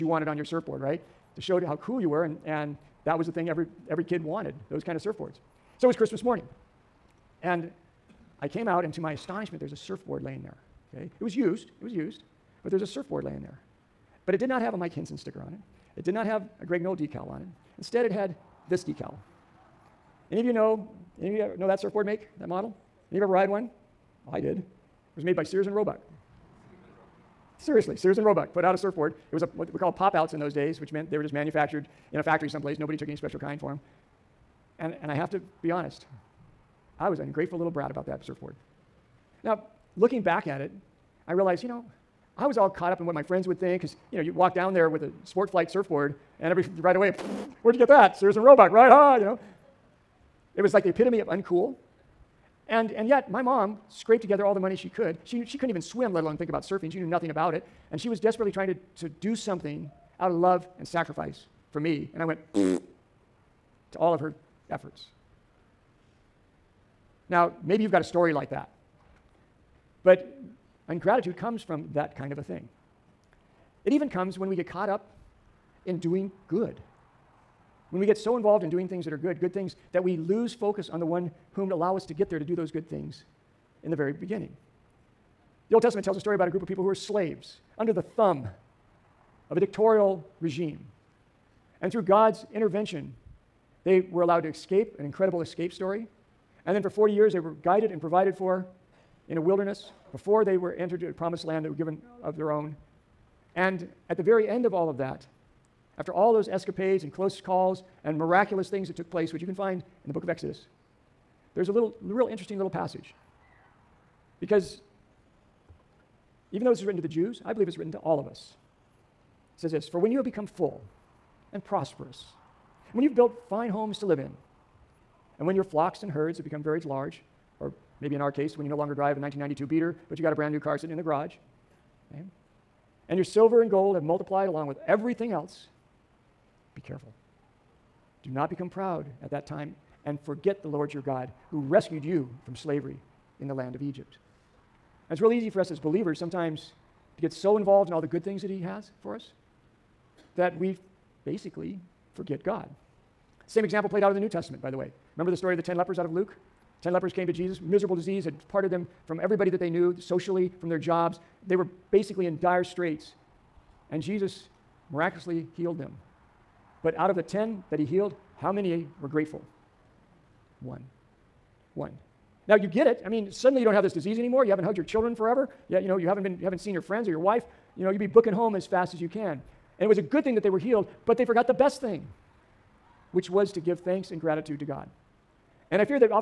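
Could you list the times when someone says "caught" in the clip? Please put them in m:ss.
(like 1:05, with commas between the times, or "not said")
0:42, 1:14.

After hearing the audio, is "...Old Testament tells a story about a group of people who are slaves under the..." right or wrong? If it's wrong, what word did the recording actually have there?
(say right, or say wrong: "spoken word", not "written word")
right.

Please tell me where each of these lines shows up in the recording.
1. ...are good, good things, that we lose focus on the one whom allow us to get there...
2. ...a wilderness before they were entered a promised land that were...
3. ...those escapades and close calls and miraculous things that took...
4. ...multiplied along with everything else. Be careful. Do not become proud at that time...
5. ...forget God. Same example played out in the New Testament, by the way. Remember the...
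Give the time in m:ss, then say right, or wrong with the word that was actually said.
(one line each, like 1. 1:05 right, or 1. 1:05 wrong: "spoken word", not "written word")
1. 1:19 right
2. 1:39 right
3. 1:46 right
4. 2:14 right
5. 2:32 right.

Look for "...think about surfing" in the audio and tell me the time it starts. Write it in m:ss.
0:56.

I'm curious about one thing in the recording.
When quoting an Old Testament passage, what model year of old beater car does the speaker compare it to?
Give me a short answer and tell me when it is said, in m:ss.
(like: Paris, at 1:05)
1992, at 2:09.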